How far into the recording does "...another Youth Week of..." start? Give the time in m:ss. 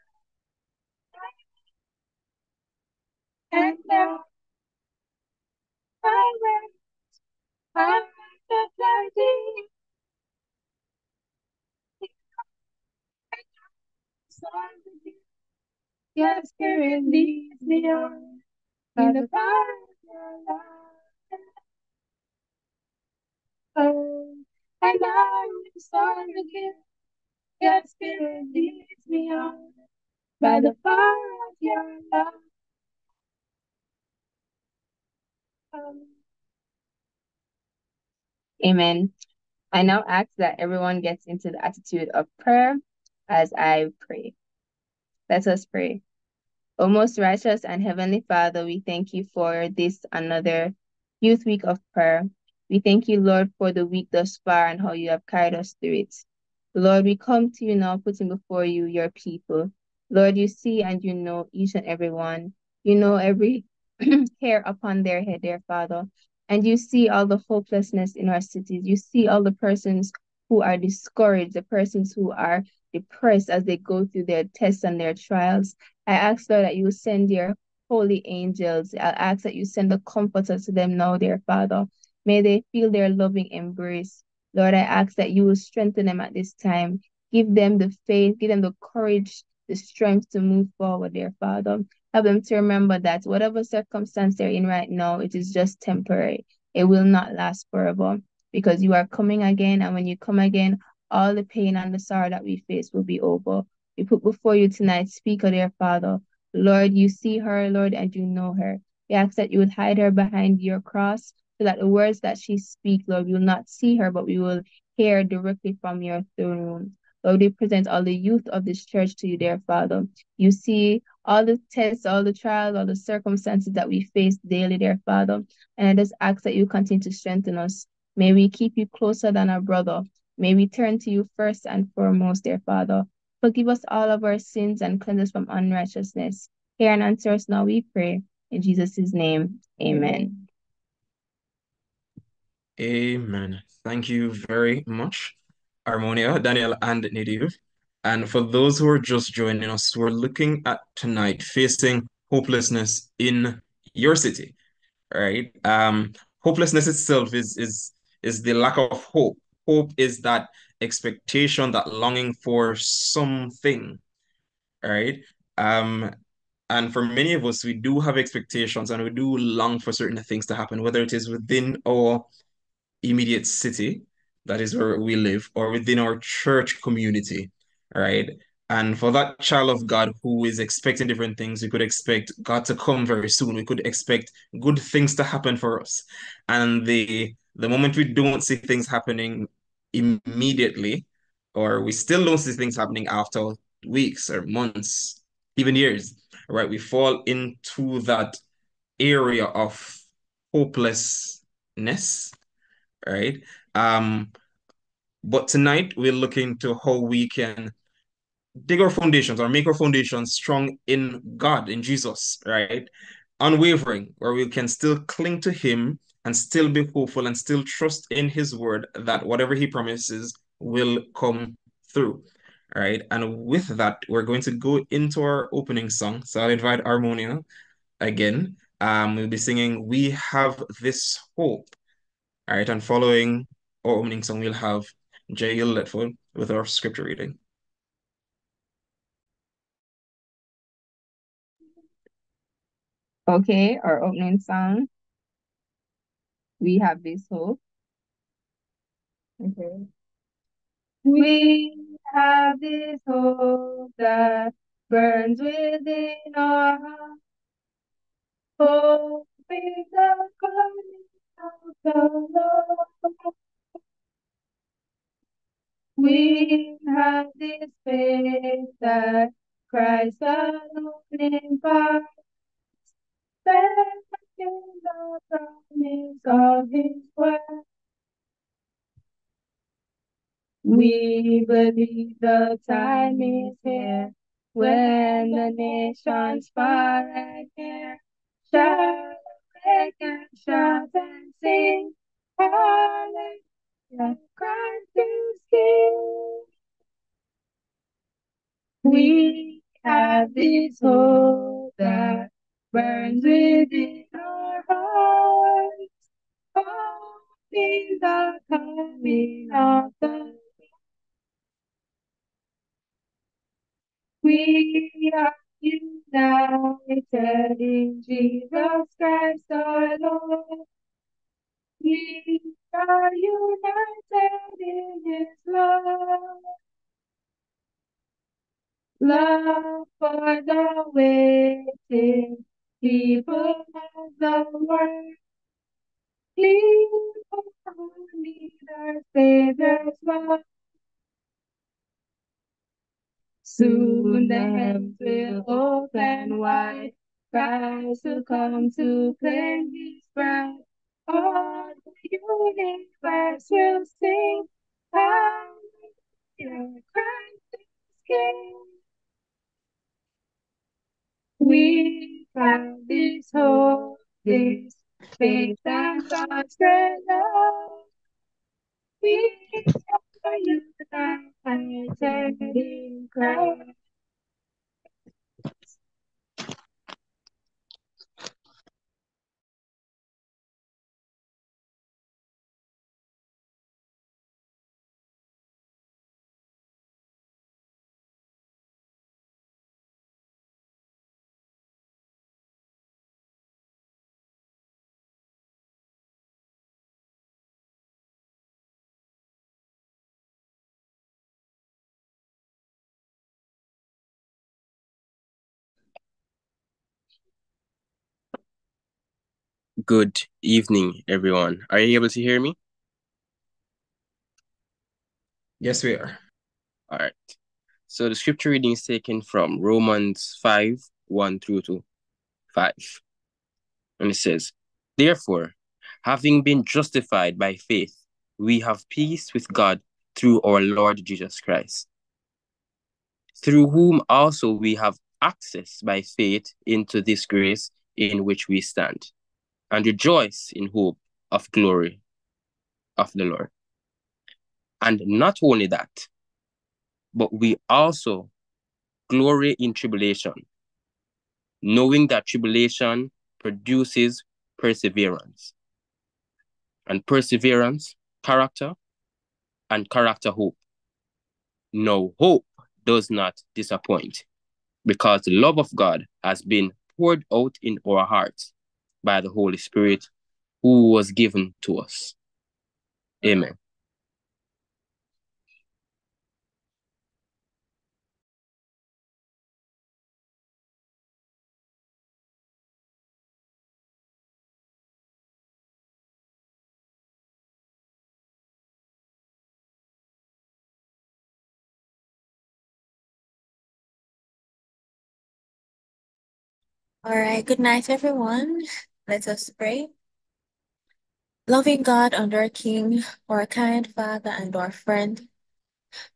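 0:50.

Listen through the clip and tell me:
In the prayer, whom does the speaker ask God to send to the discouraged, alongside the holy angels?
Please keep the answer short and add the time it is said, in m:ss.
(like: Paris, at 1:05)
the comforter, at 1:19.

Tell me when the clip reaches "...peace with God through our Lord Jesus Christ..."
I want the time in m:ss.
7:08.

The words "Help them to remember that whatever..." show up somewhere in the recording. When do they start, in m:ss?
1:32.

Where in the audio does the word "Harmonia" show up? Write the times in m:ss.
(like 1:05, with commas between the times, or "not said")
2:25, 3:46.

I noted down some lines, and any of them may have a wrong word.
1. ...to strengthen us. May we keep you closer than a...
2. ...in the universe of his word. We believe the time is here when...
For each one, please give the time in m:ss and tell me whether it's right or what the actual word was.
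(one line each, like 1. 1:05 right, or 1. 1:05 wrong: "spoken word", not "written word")
1. 2:07 right
2. 4:34 wrong: "promise", not "universe".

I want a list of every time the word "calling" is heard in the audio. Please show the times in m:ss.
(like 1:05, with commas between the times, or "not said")
4:20.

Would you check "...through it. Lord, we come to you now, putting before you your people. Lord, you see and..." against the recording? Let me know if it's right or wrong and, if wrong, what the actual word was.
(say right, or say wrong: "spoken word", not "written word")
right.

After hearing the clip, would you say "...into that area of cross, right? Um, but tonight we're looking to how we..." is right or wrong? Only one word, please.
wrong.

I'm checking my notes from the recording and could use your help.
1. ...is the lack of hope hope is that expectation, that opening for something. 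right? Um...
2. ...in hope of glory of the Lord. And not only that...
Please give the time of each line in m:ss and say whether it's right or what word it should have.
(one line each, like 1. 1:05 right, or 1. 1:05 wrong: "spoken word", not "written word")
1. 2:38 wrong: "longing", not "opening"
2. 7:20 right.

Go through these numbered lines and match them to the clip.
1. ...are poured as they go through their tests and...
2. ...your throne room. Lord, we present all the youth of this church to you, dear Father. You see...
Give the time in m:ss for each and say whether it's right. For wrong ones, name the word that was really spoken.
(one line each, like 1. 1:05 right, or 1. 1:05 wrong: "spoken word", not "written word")
1. 1:12 wrong: "depressed", not "poured"
2. 1:56 right.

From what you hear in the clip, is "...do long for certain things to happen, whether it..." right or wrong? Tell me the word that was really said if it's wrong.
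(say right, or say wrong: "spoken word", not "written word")
right.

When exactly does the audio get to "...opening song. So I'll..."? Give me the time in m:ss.
3:45.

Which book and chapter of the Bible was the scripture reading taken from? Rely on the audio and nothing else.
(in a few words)
Romans 5.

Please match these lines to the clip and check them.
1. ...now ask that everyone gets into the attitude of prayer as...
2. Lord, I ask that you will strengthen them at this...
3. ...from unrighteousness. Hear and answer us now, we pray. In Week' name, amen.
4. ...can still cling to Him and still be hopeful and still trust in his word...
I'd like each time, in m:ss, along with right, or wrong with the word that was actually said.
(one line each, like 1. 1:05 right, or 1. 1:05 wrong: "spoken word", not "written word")
1. 0:39 right
2. 1:24 right
3. 2:15 wrong: "Jesus", not "Week"
4. 3:34 right.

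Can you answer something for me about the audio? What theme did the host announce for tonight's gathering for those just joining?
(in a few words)
facing hopelessness in your city.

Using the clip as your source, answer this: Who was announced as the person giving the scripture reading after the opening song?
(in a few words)
J.L. Letford.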